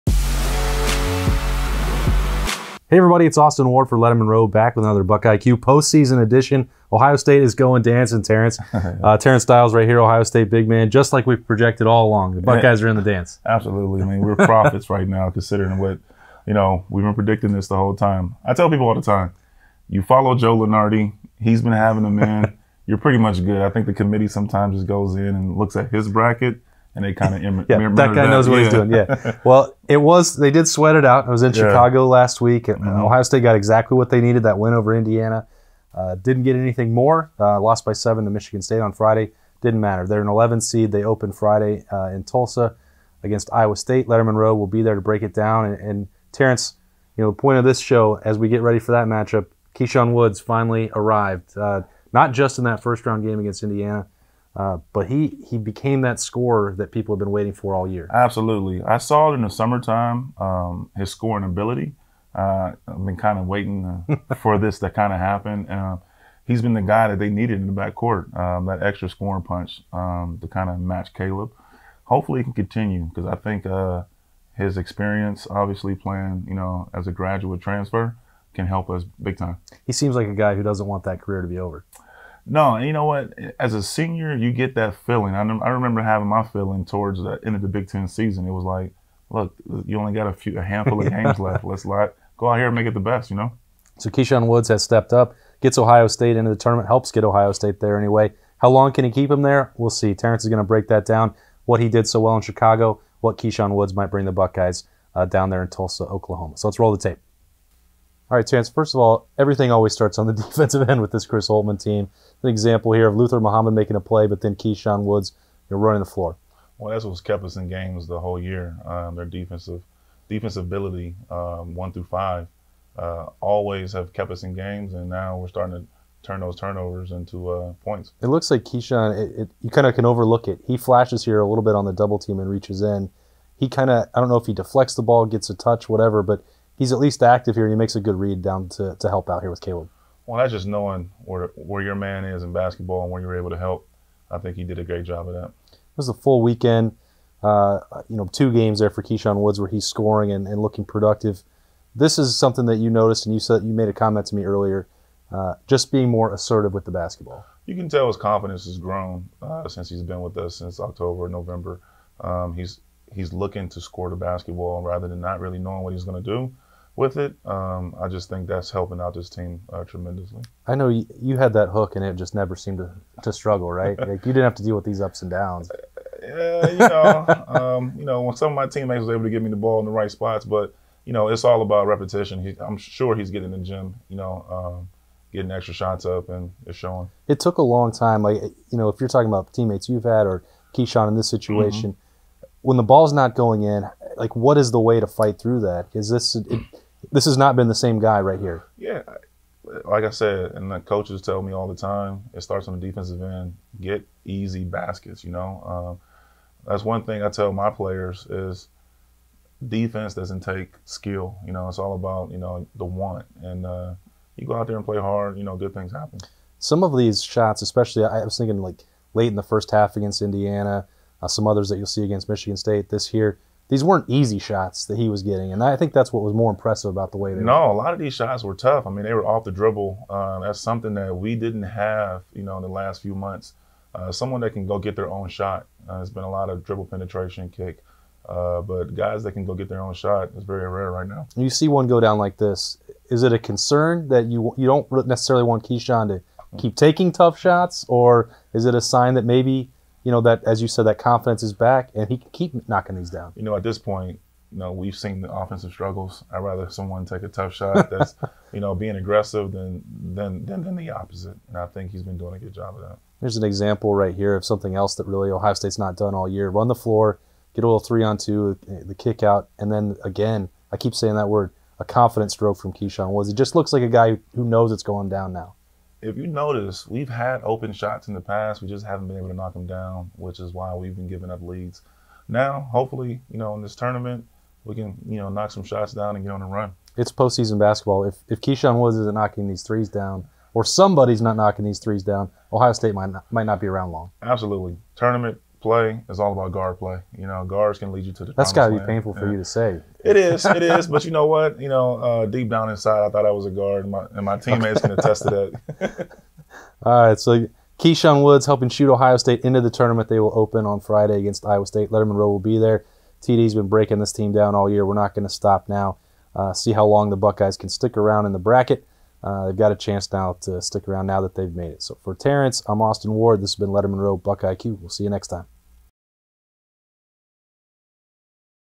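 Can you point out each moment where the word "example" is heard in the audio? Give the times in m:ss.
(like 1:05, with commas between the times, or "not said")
1:52, 4:23.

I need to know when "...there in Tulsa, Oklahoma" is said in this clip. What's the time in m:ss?
1:45.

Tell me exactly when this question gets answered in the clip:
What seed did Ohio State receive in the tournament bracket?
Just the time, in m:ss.
0:40.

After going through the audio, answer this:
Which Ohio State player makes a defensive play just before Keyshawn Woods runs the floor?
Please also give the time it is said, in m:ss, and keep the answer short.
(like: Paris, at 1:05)
Luther Muhammad, at 1:53.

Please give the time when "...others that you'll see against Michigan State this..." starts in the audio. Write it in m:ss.
3:41.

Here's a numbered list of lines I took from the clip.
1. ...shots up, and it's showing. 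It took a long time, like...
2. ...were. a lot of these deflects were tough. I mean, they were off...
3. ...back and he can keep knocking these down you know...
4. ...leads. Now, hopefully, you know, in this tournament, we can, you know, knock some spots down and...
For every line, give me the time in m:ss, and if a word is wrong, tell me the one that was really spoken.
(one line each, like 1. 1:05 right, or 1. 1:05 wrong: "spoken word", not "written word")
1. 3:05 right
2. 3:47 wrong: "shots", not "deflects"
3. 4:11 right
4. 4:41 wrong: "shots", not "spots".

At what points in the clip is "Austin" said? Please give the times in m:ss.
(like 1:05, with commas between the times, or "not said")
0:03, 5:22.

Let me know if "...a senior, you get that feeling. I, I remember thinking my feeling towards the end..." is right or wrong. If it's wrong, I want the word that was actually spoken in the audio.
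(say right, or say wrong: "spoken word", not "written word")
wrong: "having", not "thinking".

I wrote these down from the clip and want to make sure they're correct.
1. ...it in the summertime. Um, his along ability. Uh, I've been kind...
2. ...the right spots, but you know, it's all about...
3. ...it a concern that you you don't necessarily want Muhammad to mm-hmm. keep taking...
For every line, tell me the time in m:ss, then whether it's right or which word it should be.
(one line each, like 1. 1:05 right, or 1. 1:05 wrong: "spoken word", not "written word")
1. 0:59 wrong: "scoring", not "along"
2. 2:59 right
3. 4:03 wrong: "Keyshawn", not "Muhammad".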